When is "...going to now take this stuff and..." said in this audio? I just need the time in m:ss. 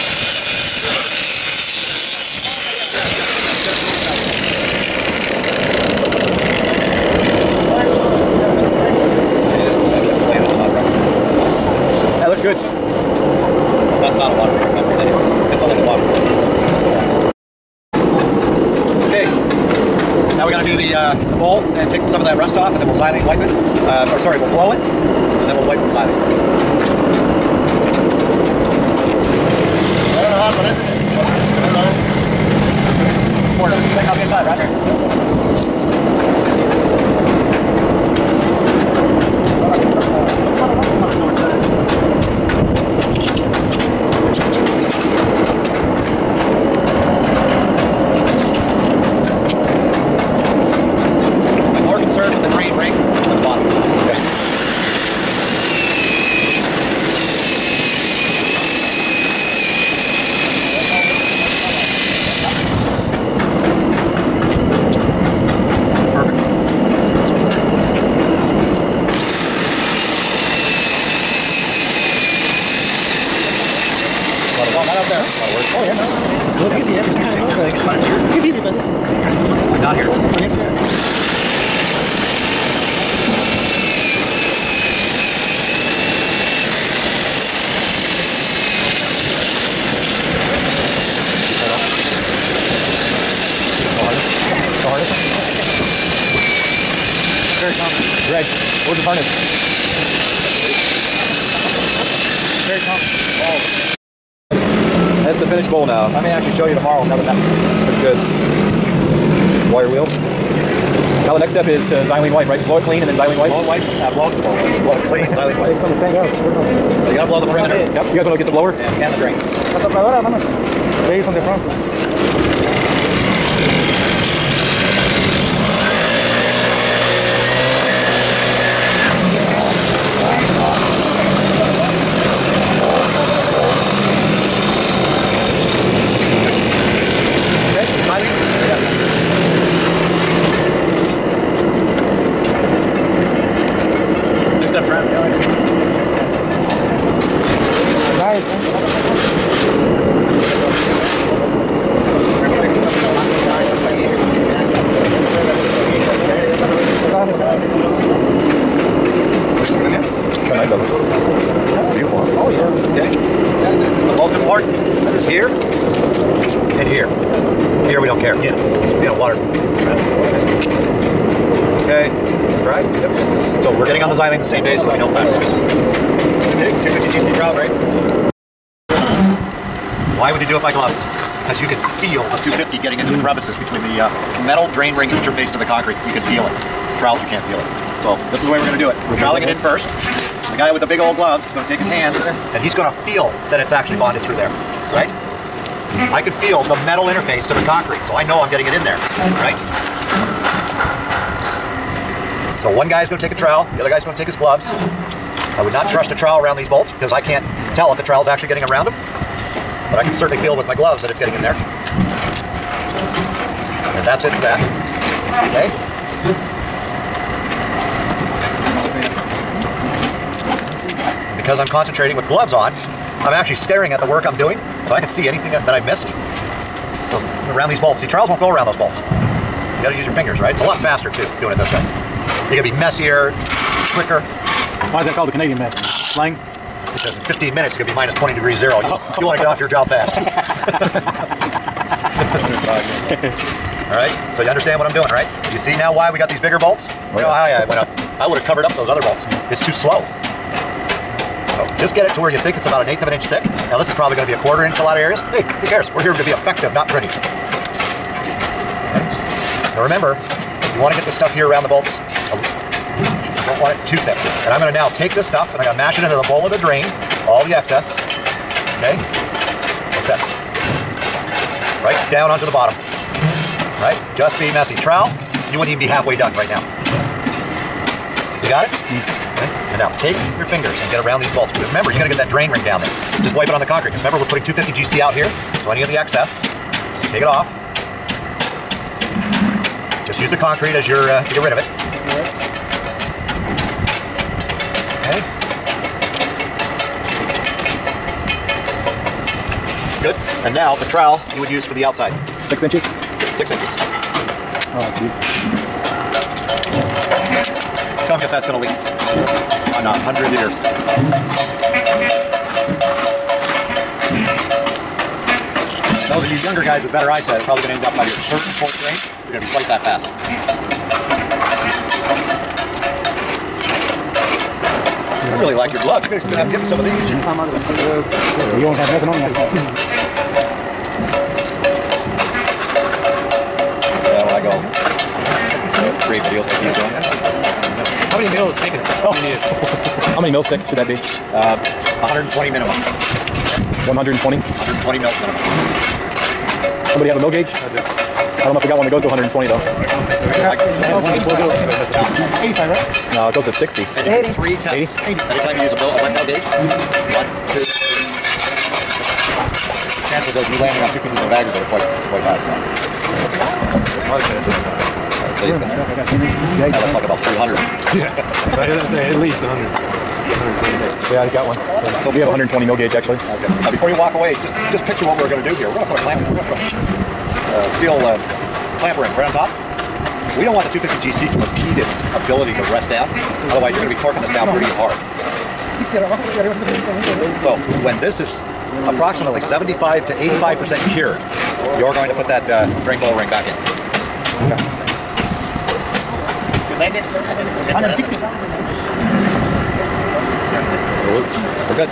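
4:24.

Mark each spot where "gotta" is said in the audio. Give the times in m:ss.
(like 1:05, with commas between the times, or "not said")
1:57, 3:49, 4:41.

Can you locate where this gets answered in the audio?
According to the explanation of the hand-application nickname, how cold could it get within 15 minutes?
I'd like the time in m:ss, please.
3:57.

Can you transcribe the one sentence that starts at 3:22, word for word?
So one guy is going to take a trowel, the other guy is going to take his gloves.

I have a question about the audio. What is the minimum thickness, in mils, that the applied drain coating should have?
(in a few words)
120 mils.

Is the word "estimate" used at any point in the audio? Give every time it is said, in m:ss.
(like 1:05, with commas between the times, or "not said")
not said.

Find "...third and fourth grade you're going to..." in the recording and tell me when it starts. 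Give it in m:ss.
5:18.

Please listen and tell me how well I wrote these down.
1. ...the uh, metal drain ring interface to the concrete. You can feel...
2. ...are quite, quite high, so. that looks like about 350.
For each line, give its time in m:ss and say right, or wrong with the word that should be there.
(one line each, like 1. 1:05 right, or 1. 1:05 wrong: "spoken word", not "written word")
1. 3:03 right
2. 6:01 wrong: "300", not "350".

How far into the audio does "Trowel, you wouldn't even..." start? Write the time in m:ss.
4:34.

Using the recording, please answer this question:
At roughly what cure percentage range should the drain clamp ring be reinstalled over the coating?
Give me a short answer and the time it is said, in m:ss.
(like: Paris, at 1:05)
75 to 85%, at 6:29.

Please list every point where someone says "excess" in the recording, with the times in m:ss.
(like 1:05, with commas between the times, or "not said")
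4:27, 4:45.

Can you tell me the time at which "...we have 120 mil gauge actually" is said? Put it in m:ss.
6:12.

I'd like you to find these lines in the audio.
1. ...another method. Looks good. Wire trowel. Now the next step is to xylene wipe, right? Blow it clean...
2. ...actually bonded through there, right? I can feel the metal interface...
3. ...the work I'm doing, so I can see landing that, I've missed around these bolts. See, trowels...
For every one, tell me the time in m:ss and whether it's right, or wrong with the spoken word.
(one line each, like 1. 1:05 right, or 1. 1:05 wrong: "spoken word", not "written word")
1. 1:47 wrong: "wheel", not "trowel"
2. 3:13 right
3. 3:43 wrong: "anything", not "landing".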